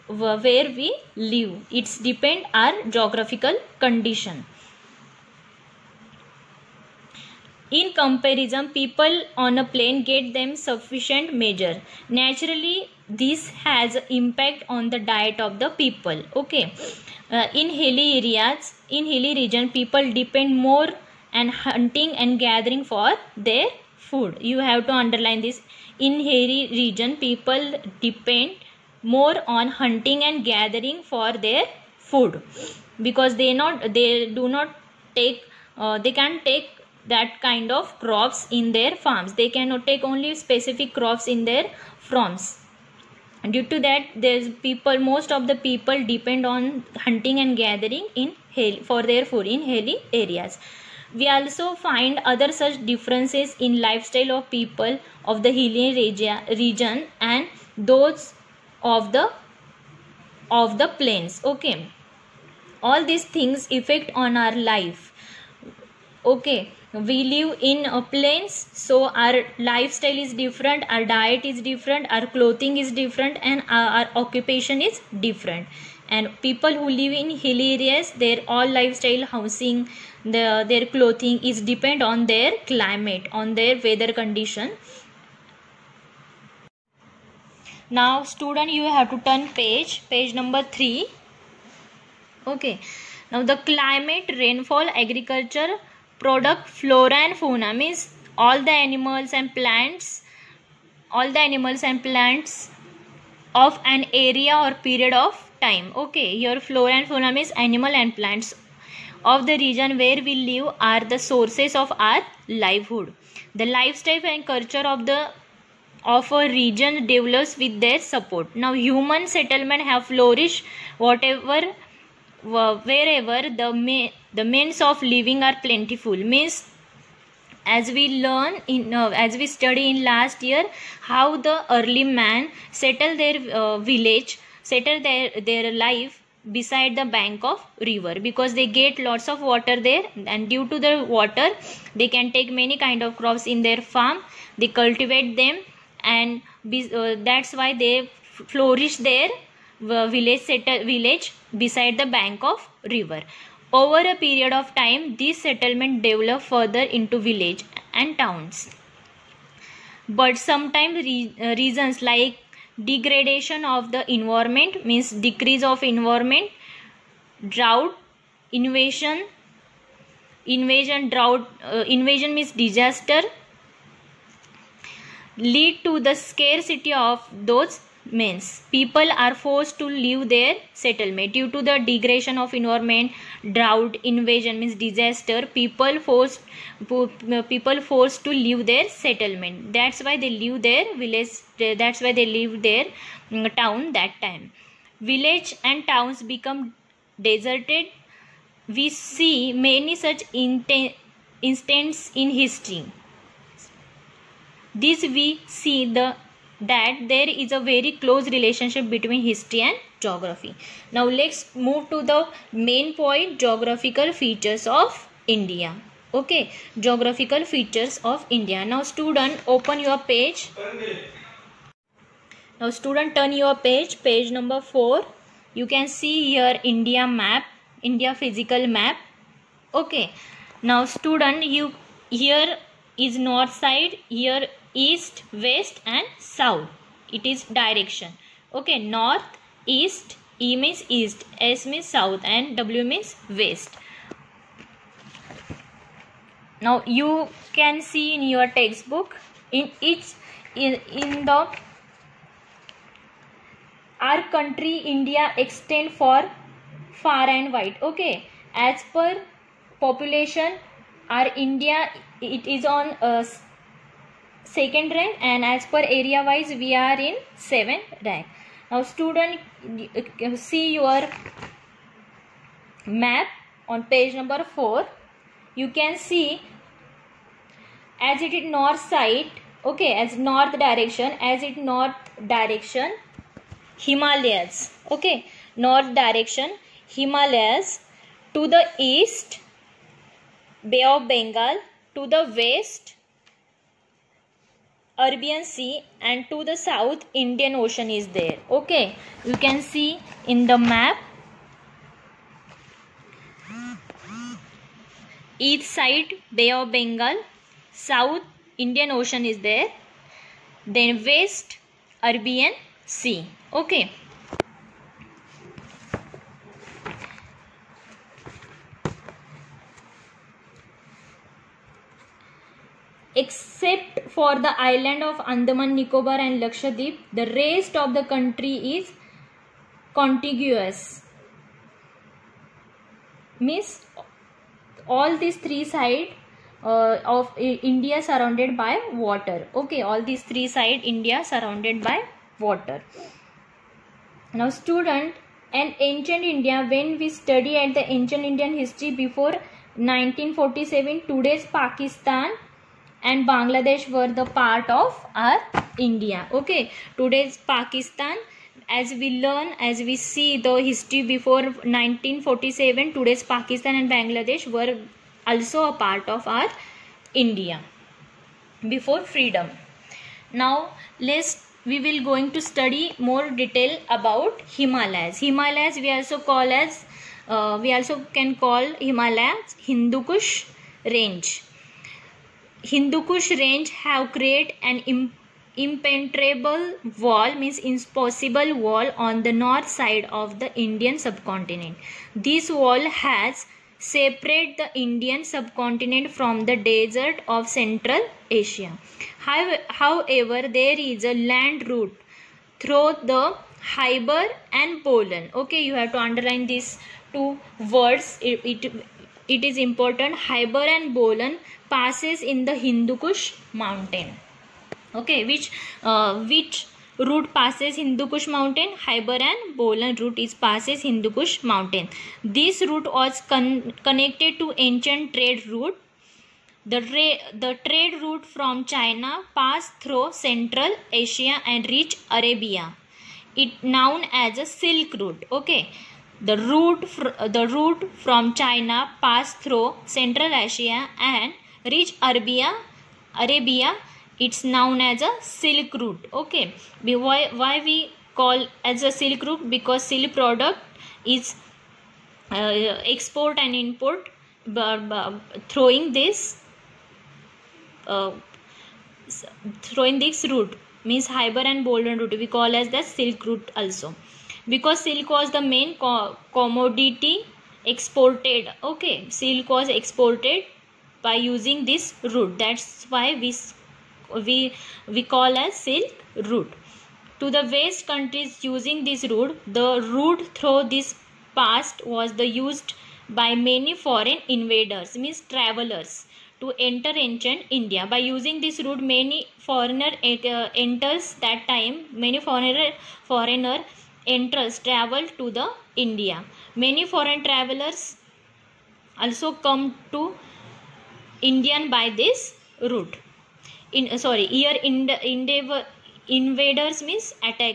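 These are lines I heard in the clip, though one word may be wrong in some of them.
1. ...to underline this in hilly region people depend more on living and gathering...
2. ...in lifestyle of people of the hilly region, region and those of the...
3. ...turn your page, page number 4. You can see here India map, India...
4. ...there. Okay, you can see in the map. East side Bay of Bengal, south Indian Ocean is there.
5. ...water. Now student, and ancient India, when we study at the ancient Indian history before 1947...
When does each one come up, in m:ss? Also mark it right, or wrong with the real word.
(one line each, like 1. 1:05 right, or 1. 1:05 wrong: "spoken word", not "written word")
1. 0:24 wrong: "hunting", not "living"
2. 0:53 right
3. 3:43 right
4. 4:58 right
5. 5:42 right.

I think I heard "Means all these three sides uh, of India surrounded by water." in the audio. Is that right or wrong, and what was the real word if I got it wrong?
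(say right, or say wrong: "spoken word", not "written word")
right.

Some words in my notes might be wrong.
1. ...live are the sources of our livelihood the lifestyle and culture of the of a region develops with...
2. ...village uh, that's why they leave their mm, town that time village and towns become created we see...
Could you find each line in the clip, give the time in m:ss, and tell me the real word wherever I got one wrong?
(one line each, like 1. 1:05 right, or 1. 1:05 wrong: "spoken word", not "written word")
1. 1:50 right
2. 3:10 wrong: "deserted", not "created".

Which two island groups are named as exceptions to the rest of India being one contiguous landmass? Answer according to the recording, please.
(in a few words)
Andaman Nicobar and Lakshadweep.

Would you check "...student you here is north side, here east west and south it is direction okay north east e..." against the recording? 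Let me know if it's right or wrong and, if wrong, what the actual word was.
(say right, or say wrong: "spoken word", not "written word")
right.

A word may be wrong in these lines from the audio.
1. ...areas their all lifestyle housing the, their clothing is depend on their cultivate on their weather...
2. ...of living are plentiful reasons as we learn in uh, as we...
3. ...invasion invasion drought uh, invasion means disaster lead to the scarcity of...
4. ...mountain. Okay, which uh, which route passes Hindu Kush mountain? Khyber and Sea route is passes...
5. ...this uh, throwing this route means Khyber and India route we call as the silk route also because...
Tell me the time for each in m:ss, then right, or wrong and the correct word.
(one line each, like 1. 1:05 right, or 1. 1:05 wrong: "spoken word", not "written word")
1. 1:17 wrong: "climate", not "cultivate"
2. 2:04 wrong: "means", not "reasons"
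3. 2:48 right
4. 6:53 wrong: "Bolan", not "Sea"
5. 7:35 wrong: "Bolan", not "India".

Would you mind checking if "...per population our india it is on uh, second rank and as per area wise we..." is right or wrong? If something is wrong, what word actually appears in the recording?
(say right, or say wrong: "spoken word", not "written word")
right.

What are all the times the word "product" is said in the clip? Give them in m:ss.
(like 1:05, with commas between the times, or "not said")
1:36, 7:30.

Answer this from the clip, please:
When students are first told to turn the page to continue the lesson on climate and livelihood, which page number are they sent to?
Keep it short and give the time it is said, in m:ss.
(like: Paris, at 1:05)
3, at 1:30.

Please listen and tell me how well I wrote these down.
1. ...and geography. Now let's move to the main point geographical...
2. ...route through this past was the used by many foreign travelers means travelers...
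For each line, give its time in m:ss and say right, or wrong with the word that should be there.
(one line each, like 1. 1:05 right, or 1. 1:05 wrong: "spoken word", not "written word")
1. 3:29 right
2. 7:59 wrong: "invaders", not "travelers".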